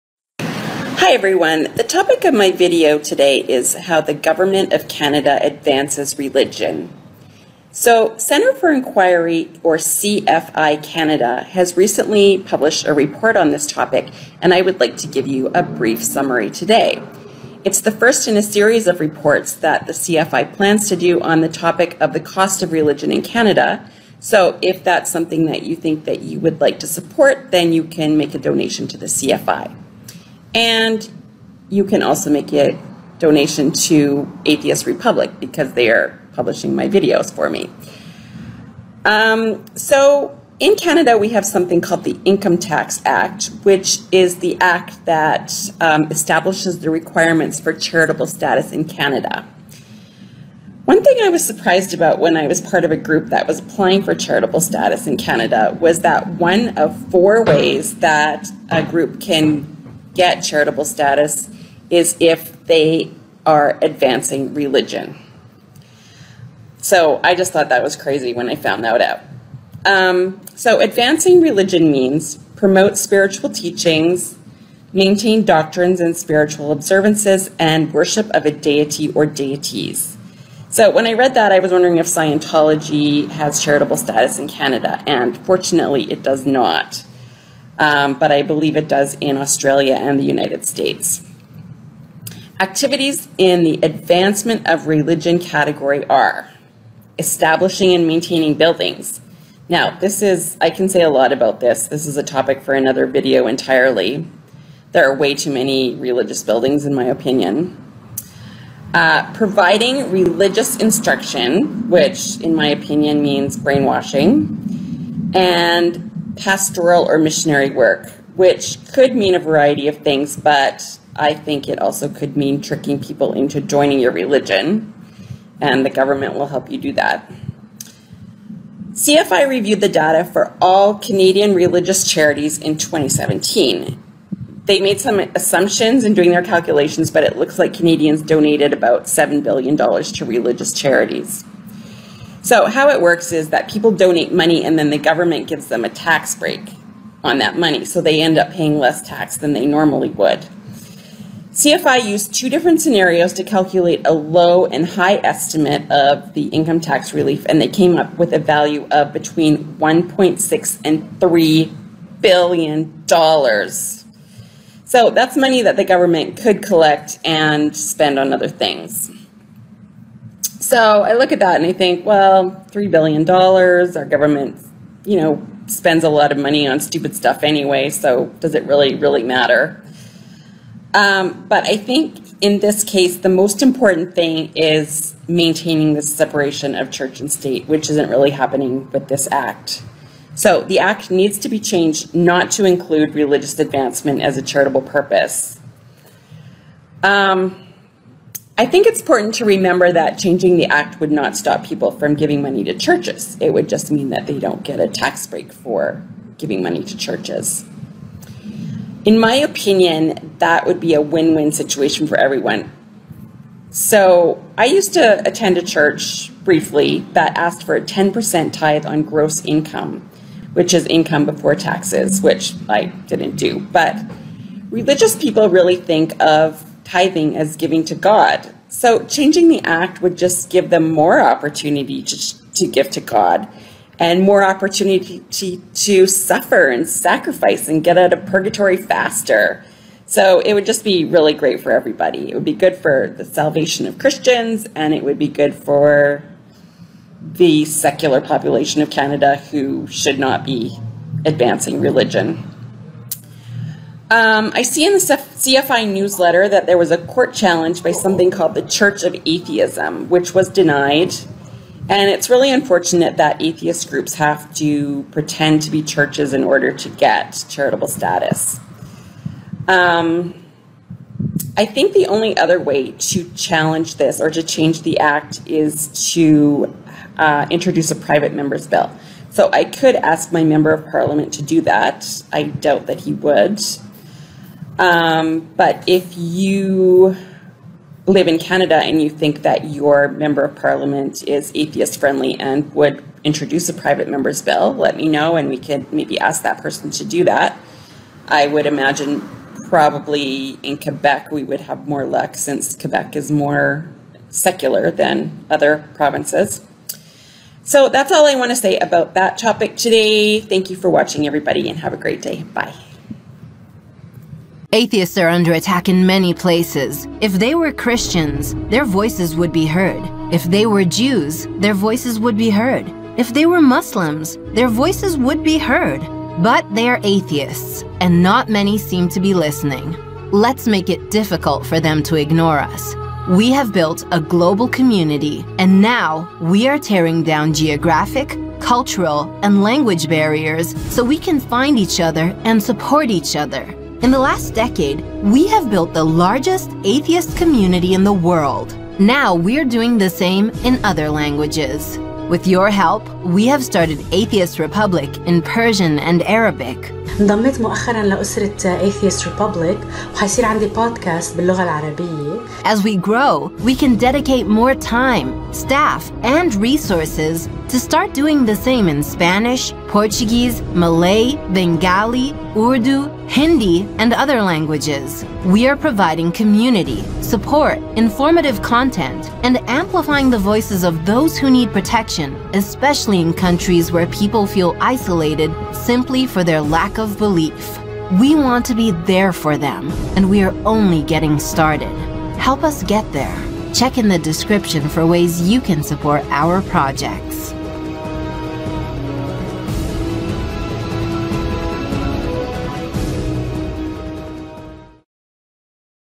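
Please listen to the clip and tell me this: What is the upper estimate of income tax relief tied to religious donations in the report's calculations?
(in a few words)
3 billion dollars.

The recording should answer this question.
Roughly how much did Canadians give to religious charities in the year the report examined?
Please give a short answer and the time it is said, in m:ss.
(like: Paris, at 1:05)
$7 billion, at 2:19.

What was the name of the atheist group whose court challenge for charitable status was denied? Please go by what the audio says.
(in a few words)
Church of Atheism.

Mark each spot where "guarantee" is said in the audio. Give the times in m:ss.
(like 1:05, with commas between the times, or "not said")
not said.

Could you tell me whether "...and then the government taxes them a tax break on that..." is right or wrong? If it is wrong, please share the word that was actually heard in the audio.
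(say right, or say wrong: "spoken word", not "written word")
wrong: "gives", not "taxes".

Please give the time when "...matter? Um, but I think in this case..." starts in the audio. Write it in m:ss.
2:59.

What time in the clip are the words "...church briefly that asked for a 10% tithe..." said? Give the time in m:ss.
3:35.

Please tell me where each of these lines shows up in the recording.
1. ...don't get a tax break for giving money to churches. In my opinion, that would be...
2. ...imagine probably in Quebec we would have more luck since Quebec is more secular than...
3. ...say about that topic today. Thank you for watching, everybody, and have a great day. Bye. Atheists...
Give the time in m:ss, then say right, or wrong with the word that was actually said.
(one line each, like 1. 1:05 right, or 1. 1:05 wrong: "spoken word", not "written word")
1. 3:24 right
2. 4:58 right
3. 5:08 right.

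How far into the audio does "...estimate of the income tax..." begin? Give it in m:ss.
2:35.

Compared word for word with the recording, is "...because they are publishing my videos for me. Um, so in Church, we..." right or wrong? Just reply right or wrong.
wrong.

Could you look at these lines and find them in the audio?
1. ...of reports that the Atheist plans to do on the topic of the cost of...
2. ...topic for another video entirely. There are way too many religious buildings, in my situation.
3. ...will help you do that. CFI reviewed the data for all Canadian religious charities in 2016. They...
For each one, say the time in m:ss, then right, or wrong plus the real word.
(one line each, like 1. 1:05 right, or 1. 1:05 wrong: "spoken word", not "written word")
1. 0:18 wrong: "CFI", not "Atheist"
2. 1:42 wrong: "opinion", not "situation"
3. 2:06 wrong: "2017", not "2016".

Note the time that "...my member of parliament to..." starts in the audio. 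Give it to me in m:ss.
4:40.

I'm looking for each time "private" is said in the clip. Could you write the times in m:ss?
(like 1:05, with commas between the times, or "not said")
4:37, 4:53.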